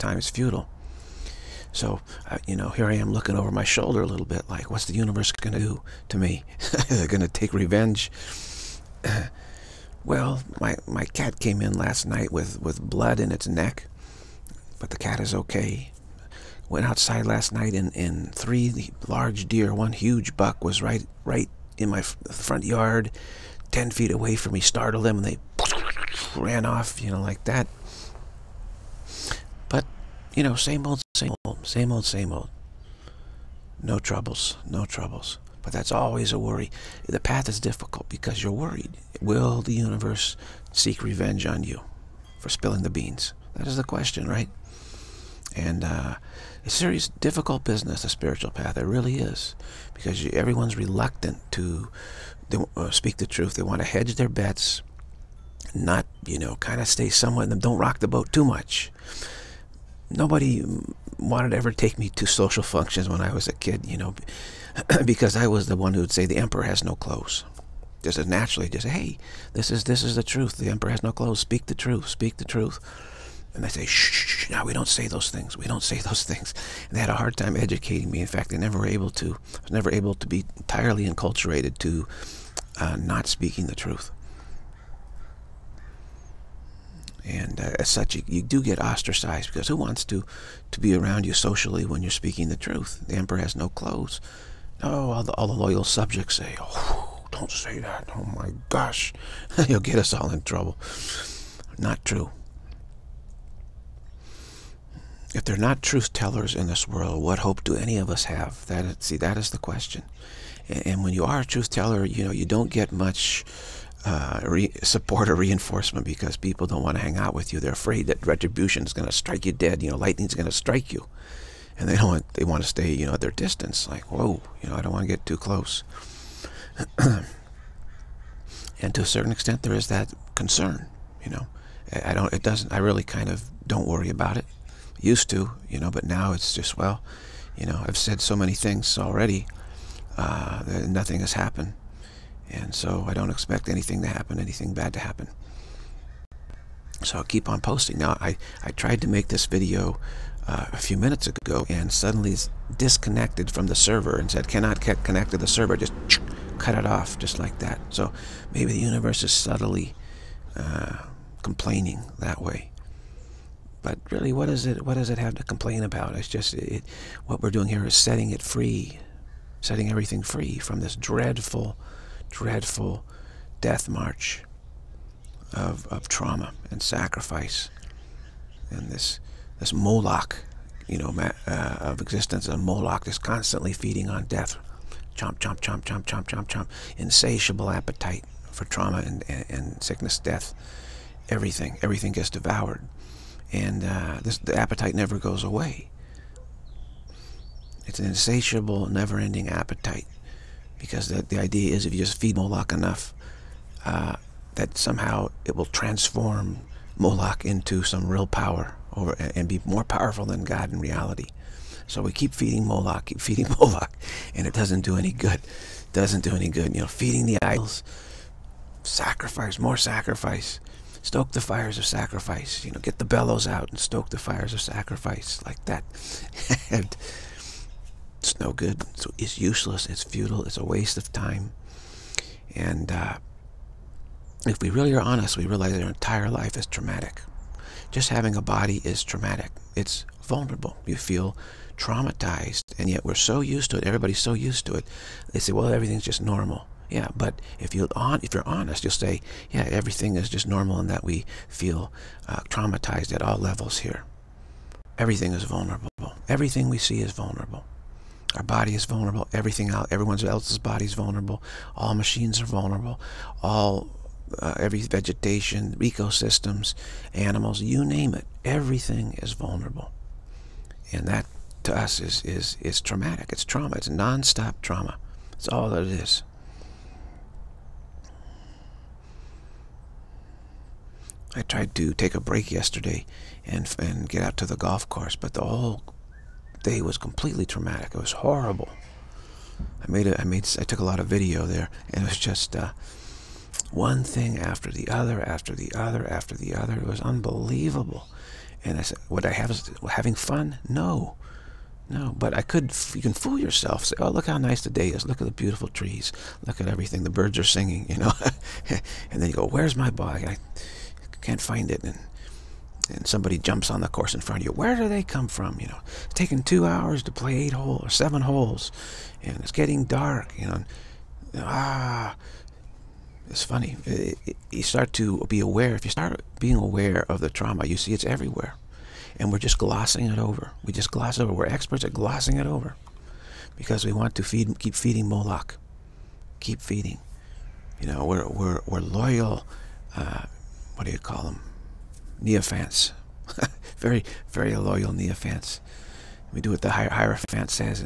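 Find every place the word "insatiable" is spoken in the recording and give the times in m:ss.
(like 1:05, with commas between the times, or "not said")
3:06, 3:18.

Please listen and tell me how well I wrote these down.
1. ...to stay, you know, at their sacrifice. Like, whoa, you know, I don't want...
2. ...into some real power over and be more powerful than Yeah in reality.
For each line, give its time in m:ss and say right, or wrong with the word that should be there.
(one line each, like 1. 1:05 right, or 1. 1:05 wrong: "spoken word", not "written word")
1. 2:02 wrong: "distance", not "sacrifice"
2. 3:27 wrong: "God", not "Yeah".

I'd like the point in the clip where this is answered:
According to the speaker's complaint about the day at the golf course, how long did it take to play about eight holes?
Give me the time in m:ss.
5:16.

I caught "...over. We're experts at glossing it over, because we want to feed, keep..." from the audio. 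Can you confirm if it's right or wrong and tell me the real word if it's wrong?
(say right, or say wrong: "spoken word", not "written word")
right.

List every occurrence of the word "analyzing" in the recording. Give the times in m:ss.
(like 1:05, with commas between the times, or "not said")
not said.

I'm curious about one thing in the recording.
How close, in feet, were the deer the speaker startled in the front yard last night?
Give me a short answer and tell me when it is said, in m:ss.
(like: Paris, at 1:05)
10 feet, at 0:23.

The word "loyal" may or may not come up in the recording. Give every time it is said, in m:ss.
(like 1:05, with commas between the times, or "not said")
1:35, 5:38, 5:44.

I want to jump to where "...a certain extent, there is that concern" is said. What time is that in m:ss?
2:09.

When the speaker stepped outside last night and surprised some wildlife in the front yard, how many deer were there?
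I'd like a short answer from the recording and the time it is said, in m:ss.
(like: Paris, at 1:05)
3, at 0:18.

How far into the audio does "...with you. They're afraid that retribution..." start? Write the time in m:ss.
1:57.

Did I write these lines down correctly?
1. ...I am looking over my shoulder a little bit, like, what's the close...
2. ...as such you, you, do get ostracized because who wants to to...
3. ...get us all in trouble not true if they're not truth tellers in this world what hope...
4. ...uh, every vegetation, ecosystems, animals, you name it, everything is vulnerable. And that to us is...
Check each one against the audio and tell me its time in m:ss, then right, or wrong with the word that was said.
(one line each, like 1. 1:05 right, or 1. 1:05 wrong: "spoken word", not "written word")
1. 0:02 wrong: "universe", not "close"
2. 1:27 right
3. 1:39 right
4. 4:24 right.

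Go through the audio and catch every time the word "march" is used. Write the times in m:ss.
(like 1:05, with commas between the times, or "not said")
2:53.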